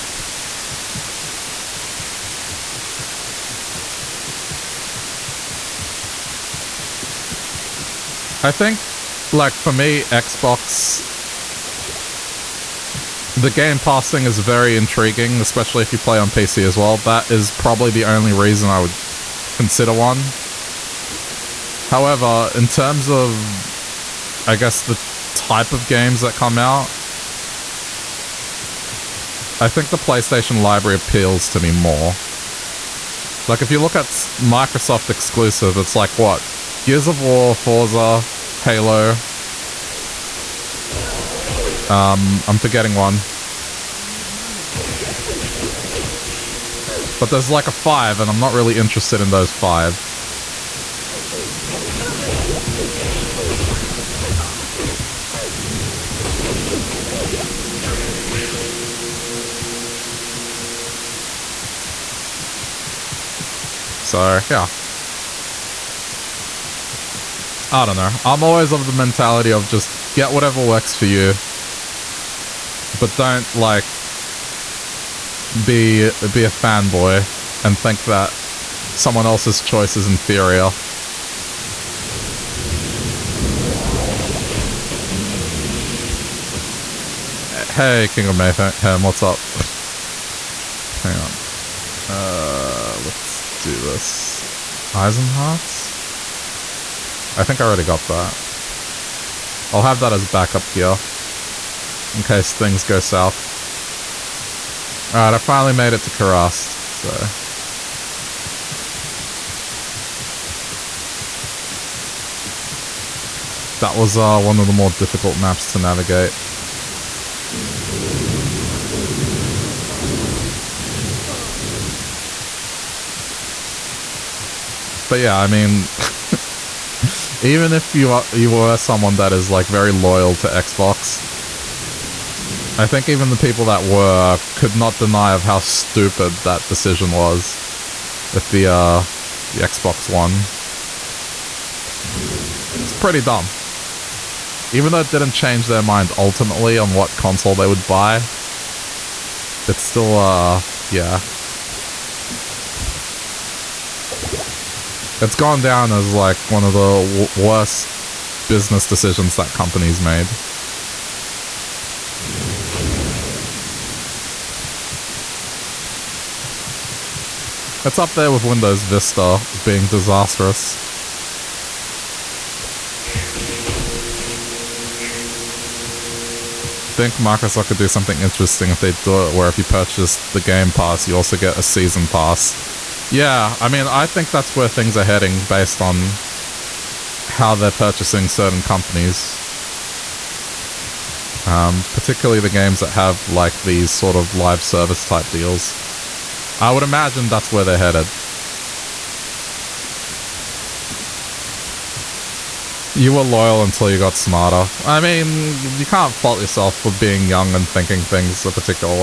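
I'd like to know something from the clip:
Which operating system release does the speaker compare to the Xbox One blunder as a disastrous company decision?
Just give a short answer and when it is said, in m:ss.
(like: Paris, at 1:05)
Windows Vista, at 2:48.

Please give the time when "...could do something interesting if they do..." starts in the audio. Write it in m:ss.
2:57.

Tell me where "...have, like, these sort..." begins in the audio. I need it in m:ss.
3:12.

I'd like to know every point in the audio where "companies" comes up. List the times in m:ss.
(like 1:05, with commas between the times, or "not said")
2:39, 3:08.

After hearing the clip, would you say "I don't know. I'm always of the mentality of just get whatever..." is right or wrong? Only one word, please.
right.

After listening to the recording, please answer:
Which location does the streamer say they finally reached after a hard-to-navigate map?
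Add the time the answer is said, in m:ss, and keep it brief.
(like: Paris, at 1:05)
Kurast, at 1:46.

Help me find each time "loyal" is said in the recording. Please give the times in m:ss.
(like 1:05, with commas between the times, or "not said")
2:09, 3:23.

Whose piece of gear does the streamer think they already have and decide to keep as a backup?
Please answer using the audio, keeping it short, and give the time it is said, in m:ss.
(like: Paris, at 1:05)
Isenhart's, at 1:34.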